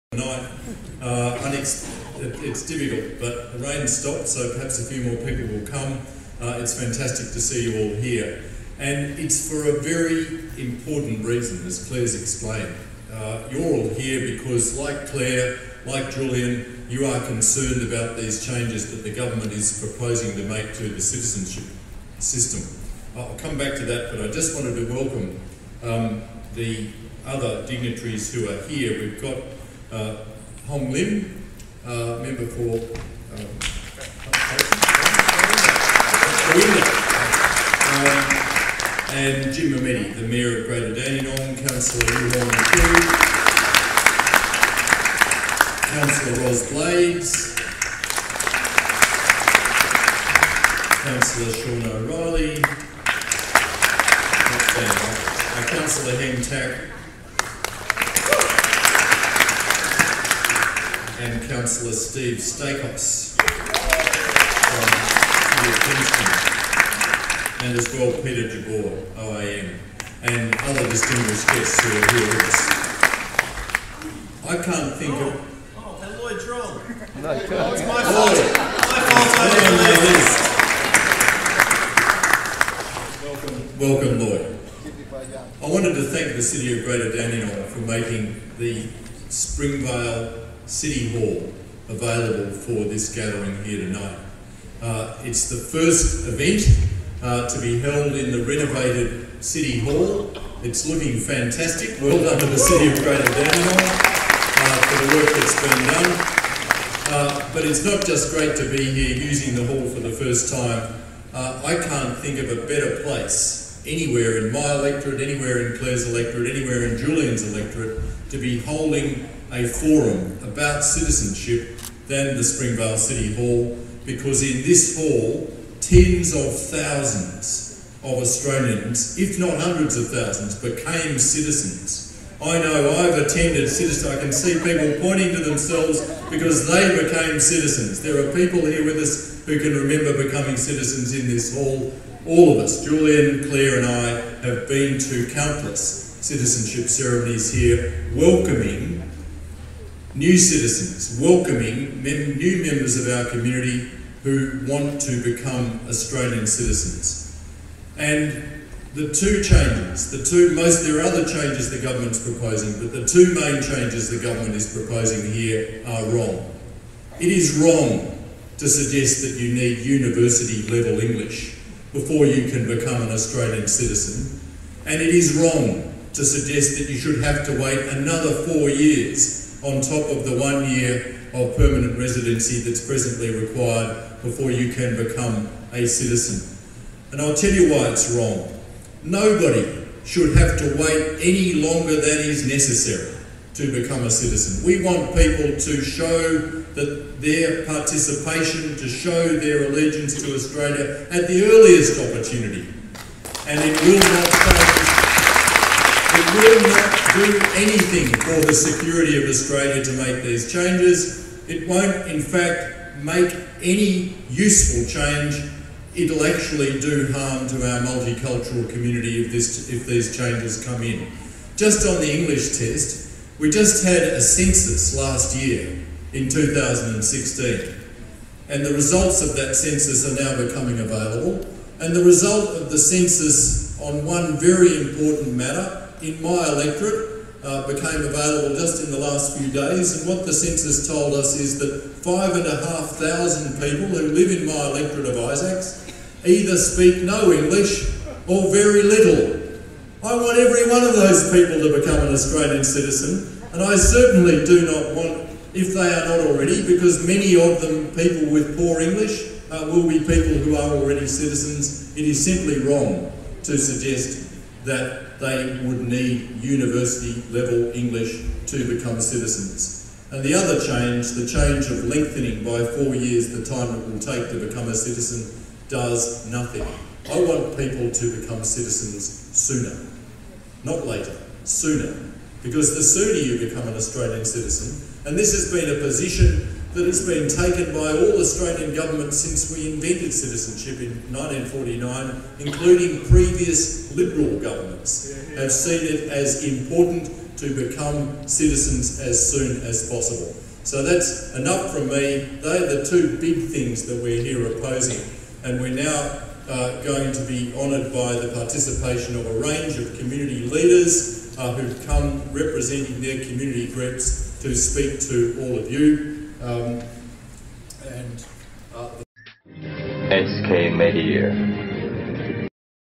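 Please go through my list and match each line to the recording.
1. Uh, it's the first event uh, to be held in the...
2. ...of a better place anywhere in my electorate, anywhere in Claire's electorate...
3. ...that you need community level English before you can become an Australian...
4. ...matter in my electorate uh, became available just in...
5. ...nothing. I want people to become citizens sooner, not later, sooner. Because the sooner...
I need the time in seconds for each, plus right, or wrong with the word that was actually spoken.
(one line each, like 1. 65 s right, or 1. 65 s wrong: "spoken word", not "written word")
1. 94 s right
2. 112 s right
3. 169 s wrong: "university", not "community"
4. 235 s right
5. 276 s right.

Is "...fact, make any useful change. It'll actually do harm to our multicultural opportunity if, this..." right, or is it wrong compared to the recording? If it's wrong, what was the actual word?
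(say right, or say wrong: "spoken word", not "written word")
wrong: "community", not "opportunity".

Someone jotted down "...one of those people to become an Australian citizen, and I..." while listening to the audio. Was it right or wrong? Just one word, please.
right.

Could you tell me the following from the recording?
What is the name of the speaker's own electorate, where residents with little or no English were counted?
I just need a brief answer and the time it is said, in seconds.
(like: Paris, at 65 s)
Isaacs, at 245 s.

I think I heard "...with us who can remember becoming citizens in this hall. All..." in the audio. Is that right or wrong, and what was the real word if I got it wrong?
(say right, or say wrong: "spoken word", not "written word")
right.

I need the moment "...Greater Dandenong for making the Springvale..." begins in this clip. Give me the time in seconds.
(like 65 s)
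86 s.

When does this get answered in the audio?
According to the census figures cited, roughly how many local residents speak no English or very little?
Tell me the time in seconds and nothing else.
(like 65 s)
242 s.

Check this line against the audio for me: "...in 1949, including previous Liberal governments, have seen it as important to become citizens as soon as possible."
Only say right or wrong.
right.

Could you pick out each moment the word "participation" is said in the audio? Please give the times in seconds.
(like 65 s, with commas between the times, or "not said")
197 s, 308 s.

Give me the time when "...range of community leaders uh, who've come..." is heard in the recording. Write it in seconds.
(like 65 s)
309 s.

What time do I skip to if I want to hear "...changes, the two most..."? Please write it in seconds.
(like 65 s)
159 s.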